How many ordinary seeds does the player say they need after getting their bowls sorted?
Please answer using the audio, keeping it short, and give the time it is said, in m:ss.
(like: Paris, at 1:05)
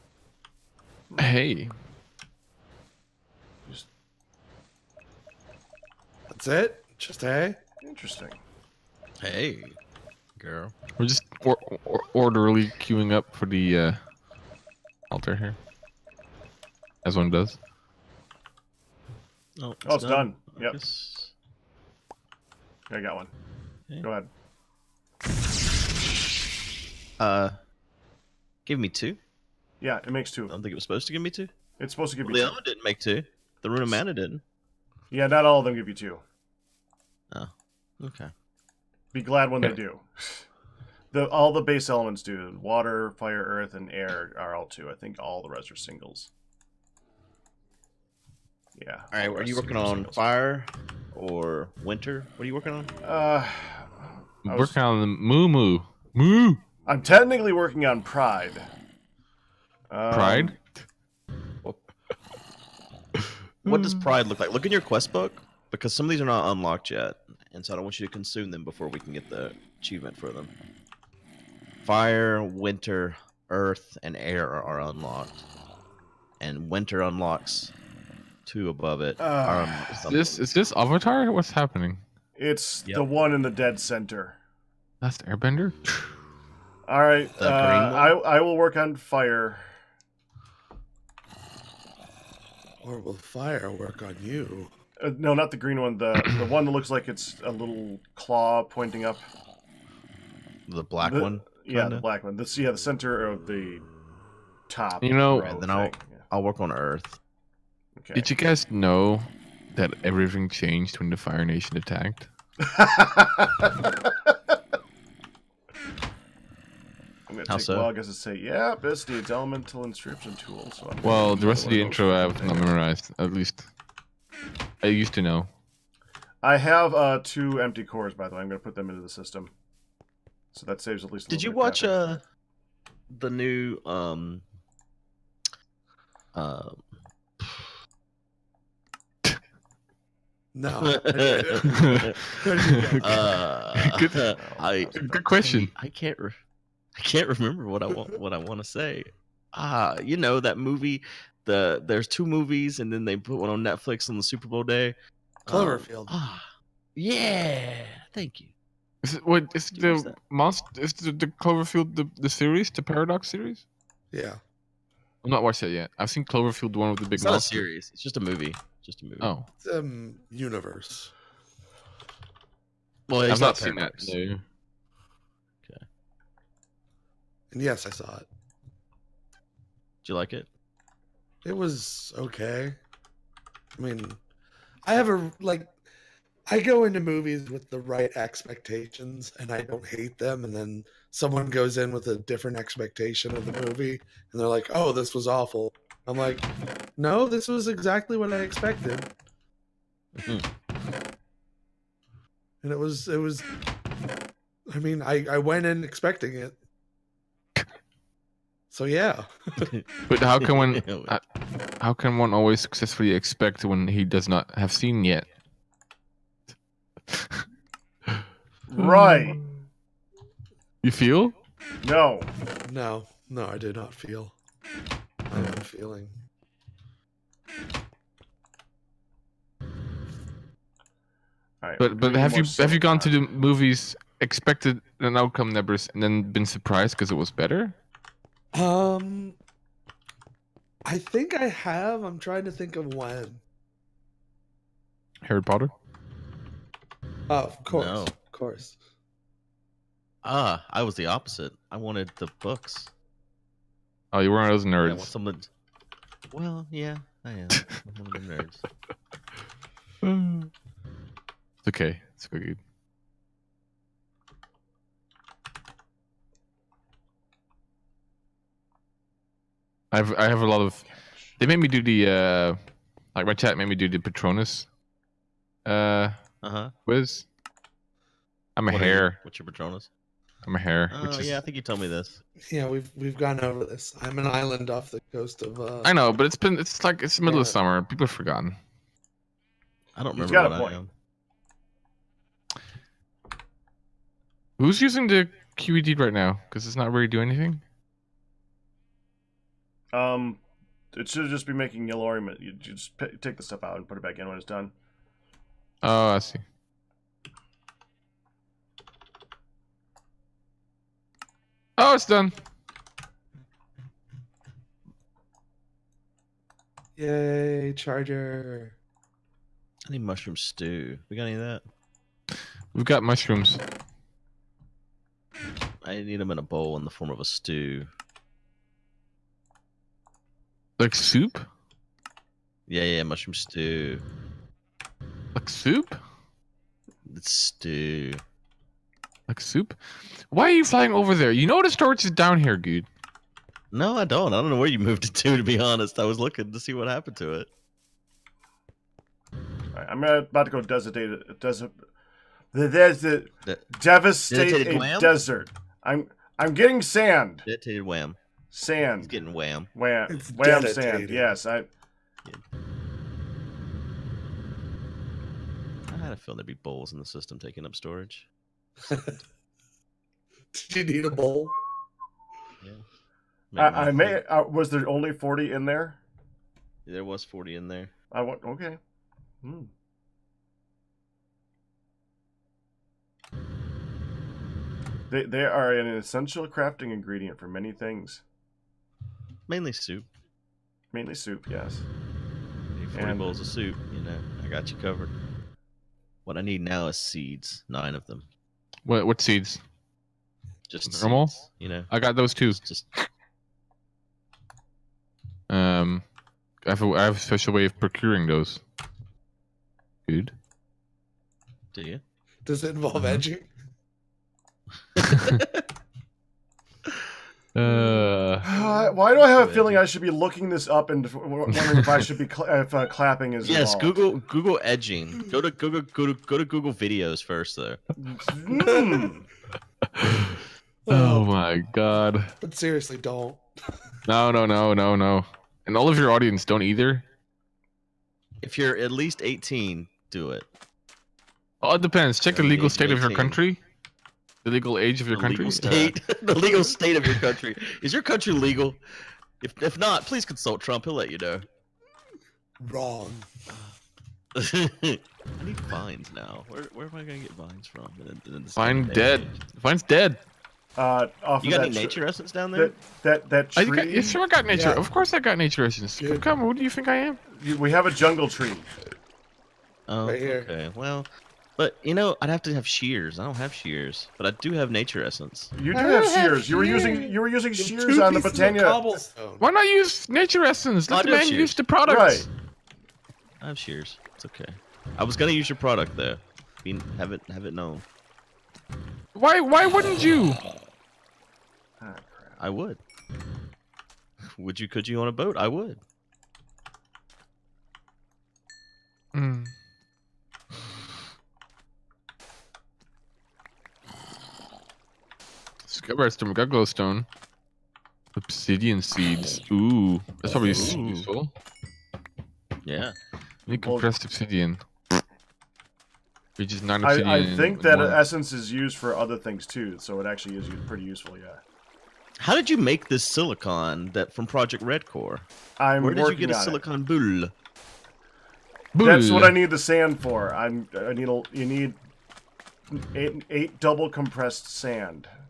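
9, at 6:37.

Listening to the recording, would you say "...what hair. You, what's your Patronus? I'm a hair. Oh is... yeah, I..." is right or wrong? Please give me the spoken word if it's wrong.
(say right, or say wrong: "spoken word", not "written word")
right.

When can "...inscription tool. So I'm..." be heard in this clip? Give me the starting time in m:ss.
1:59.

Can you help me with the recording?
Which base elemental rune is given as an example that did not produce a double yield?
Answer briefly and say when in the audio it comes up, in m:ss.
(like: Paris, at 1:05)
Rune of Mana, at 0:33.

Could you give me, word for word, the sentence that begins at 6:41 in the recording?
Seeds, you know, I got those too.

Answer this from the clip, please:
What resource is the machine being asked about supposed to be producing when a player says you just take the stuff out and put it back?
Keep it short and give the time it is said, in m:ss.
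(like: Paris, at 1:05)
Yellorium, at 5:01.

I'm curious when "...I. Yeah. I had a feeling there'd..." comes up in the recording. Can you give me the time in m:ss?
6:01.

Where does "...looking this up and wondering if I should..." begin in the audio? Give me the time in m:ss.
7:00.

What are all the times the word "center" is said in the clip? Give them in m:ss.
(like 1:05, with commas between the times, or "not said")
1:23, 1:42.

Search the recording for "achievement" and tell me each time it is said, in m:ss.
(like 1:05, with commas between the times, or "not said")
1:09.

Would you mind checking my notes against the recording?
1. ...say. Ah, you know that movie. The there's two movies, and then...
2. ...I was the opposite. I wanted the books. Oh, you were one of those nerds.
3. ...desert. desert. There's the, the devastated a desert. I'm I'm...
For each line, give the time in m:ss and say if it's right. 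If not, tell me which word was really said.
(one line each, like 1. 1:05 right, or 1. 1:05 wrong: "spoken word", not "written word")
1. 2:28 right
2. 4:10 right
3. 5:50 right.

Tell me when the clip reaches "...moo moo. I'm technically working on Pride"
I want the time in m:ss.
0:55.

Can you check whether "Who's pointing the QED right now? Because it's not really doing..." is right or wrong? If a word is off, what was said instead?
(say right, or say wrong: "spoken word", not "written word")
wrong: "using", not "pointing".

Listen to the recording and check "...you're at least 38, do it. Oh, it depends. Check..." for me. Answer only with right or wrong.
wrong.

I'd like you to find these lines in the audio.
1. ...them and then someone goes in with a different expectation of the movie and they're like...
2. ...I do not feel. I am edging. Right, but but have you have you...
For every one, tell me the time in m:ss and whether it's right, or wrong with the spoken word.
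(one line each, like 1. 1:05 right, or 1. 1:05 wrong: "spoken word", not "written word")
1. 3:10 right
2. 3:43 wrong: "feeling", not "edging".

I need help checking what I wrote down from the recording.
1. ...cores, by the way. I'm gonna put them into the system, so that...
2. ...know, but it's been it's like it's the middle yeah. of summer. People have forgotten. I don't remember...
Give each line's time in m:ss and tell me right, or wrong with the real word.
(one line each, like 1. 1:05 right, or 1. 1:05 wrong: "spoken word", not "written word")
1. 2:07 right
2. 4:45 right.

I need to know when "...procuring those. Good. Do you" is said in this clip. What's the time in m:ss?
6:47.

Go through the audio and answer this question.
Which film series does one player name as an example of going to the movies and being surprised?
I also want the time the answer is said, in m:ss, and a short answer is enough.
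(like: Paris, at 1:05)
Harry Potter, at 4:05.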